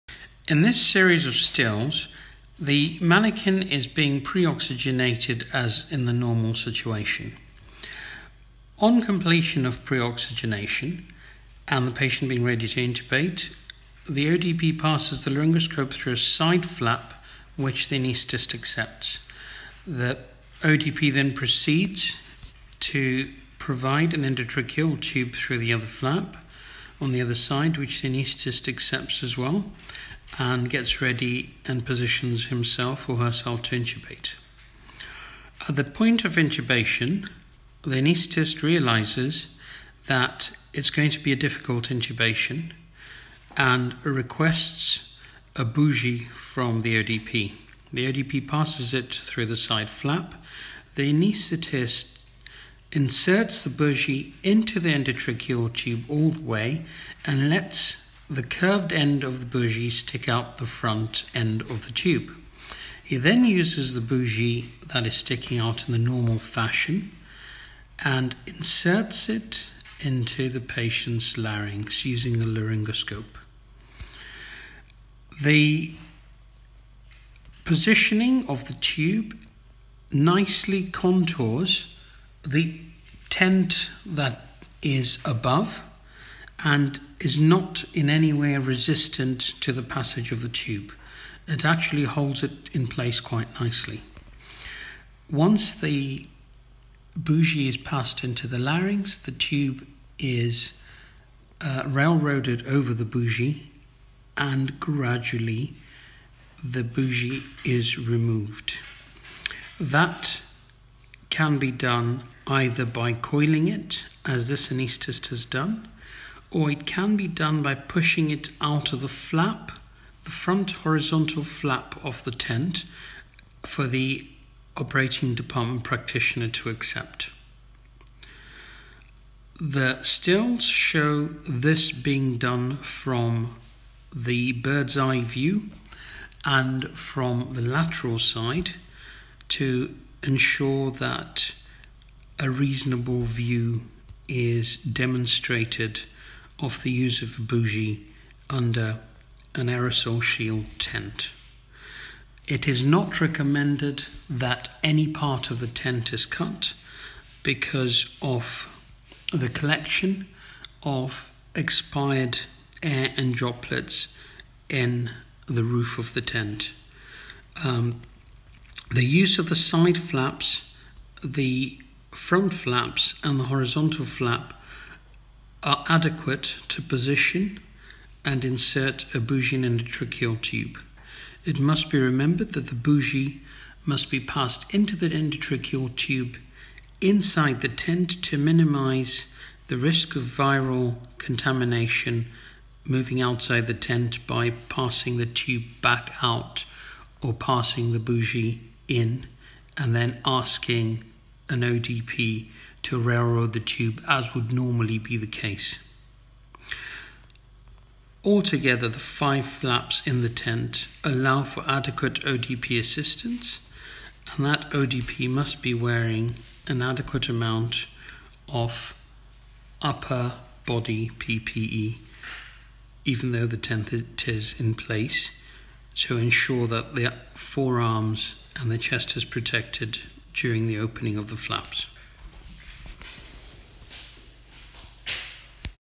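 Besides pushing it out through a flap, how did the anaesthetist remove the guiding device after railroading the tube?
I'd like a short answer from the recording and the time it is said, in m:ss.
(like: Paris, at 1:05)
coiling it, at 1:53.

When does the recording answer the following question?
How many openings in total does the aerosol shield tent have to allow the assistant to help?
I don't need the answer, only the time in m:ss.
3:28.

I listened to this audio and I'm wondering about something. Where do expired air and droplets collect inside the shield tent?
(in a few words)
roof of the tent.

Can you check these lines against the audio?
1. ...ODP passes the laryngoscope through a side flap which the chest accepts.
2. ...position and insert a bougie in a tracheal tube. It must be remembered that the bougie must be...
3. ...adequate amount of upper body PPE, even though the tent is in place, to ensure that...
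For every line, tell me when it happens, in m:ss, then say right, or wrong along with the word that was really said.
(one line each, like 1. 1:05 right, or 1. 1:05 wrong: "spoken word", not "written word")
1. 0:14 wrong: "anaesthetist", not "chest"
2. 2:56 right
3. 3:36 right.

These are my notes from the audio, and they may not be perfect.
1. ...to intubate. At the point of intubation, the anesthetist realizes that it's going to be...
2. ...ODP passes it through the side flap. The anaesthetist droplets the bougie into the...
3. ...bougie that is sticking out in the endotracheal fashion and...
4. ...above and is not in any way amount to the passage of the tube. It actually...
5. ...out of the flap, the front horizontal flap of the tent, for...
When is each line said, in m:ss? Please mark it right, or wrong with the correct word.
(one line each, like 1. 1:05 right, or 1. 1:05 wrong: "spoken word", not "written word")
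1. 0:33 wrong: "anaesthetist", not "anesthetist"
2. 0:48 wrong: "inserts", not "droplets"
3. 1:03 wrong: "normal", not "endotracheal"
4. 1:25 wrong: "resistant", not "amount"
5. 1:58 right.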